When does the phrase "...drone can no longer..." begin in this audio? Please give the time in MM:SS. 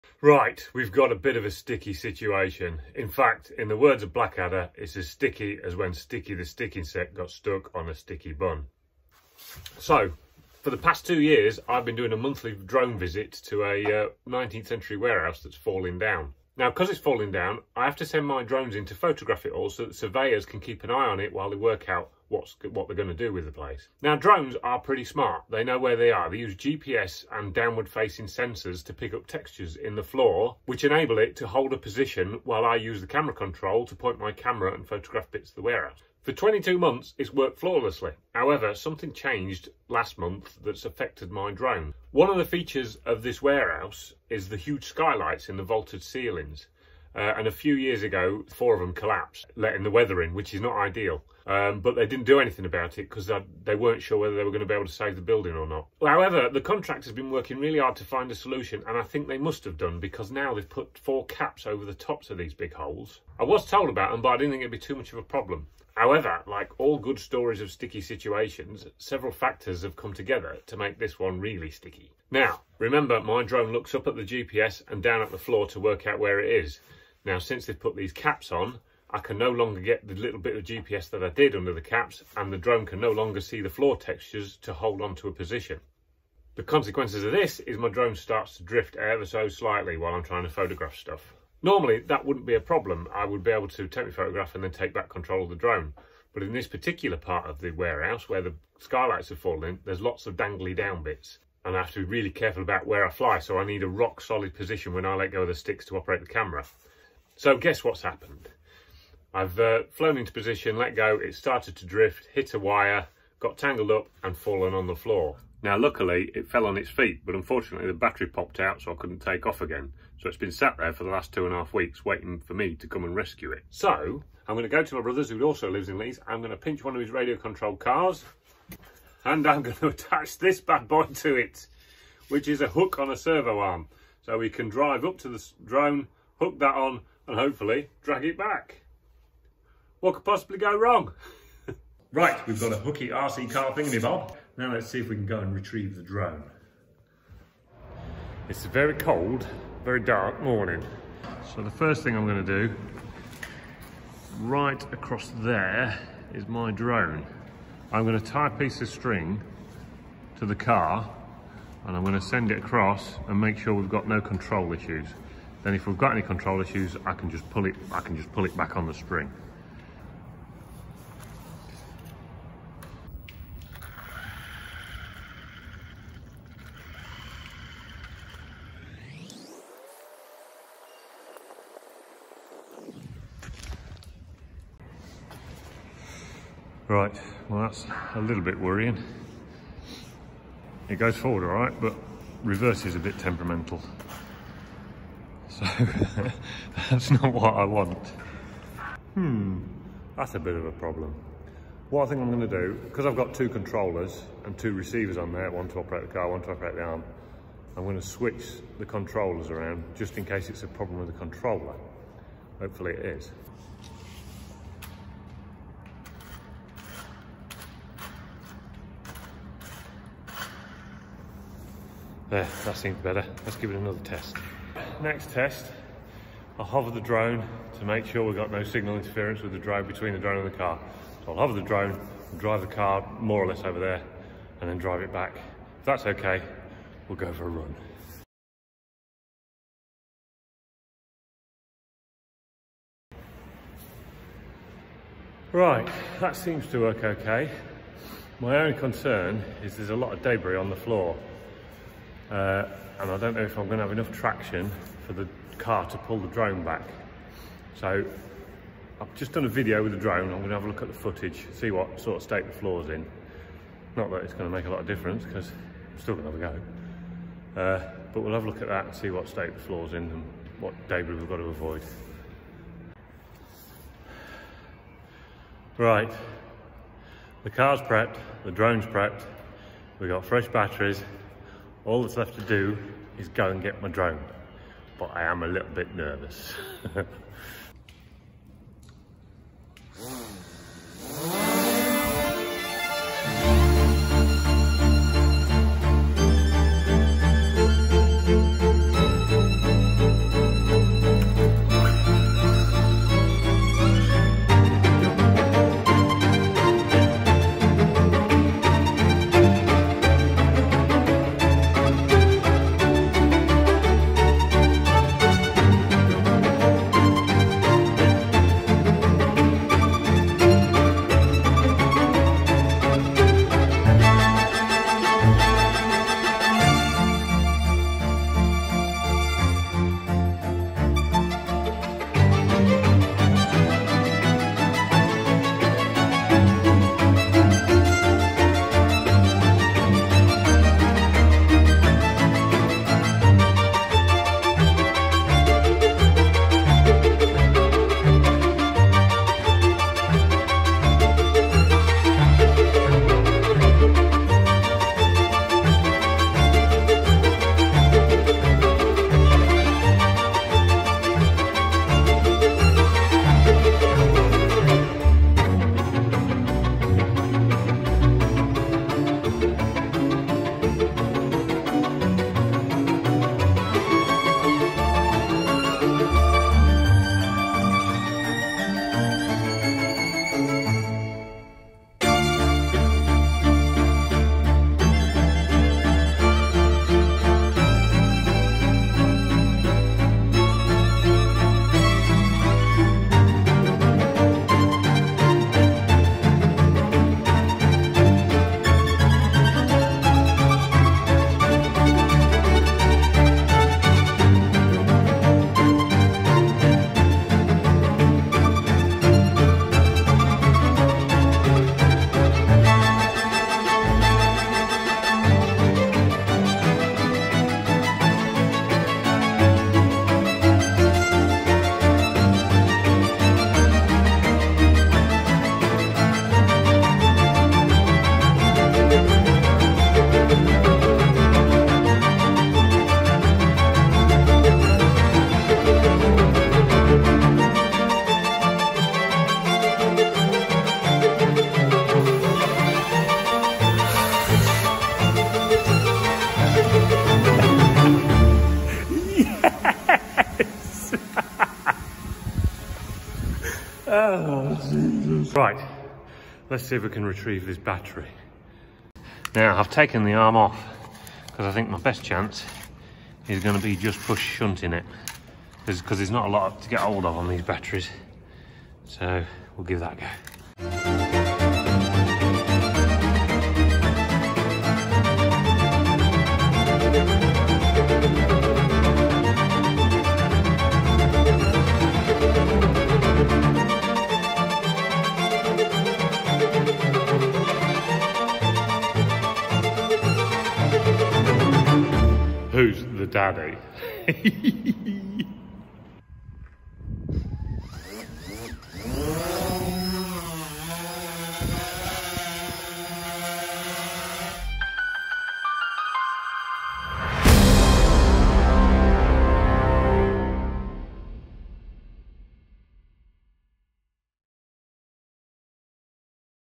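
01:22.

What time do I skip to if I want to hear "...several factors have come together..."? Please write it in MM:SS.
01:08.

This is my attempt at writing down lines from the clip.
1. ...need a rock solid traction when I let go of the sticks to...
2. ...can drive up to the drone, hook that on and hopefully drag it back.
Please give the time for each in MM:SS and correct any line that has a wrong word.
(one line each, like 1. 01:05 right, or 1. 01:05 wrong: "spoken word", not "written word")
1. 01:43 wrong: "position", not "traction"
2. 02:14 right.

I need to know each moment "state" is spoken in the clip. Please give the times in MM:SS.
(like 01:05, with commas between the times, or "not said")
04:22, 04:29.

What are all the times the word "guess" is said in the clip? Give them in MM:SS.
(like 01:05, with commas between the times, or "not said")
01:47.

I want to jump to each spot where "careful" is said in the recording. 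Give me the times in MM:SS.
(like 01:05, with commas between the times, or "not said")
01:42.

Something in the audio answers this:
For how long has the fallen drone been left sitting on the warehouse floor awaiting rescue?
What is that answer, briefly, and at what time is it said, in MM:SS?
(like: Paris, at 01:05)
two and a half weeks, at 02:01.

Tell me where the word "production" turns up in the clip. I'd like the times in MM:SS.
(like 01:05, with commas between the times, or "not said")
not said.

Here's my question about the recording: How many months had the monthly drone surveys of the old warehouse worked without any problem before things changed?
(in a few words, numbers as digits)
22.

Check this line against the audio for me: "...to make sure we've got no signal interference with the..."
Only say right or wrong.
right.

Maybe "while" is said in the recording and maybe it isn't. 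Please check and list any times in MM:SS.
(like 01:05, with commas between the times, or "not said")
00:21, 00:32, 01:29.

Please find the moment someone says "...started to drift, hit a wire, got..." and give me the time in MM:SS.
01:51.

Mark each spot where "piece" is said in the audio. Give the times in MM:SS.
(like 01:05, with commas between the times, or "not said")
02:38.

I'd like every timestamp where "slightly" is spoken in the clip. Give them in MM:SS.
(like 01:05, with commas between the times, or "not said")
01:29.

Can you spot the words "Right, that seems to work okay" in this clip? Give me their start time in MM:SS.
04:05.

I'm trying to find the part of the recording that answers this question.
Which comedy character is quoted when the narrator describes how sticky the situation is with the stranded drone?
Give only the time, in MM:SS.
00:04.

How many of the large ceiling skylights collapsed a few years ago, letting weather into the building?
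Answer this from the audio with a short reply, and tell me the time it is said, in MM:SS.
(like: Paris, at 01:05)
4, at 00:48.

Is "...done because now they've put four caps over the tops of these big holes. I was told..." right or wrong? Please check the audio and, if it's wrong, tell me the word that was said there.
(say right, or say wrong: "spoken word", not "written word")
right.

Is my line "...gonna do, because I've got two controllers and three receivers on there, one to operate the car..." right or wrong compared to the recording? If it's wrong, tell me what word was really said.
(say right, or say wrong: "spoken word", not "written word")
wrong: "two", not "three".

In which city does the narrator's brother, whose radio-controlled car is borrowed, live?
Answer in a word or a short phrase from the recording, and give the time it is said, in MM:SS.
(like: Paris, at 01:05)
Leeds, at 02:05.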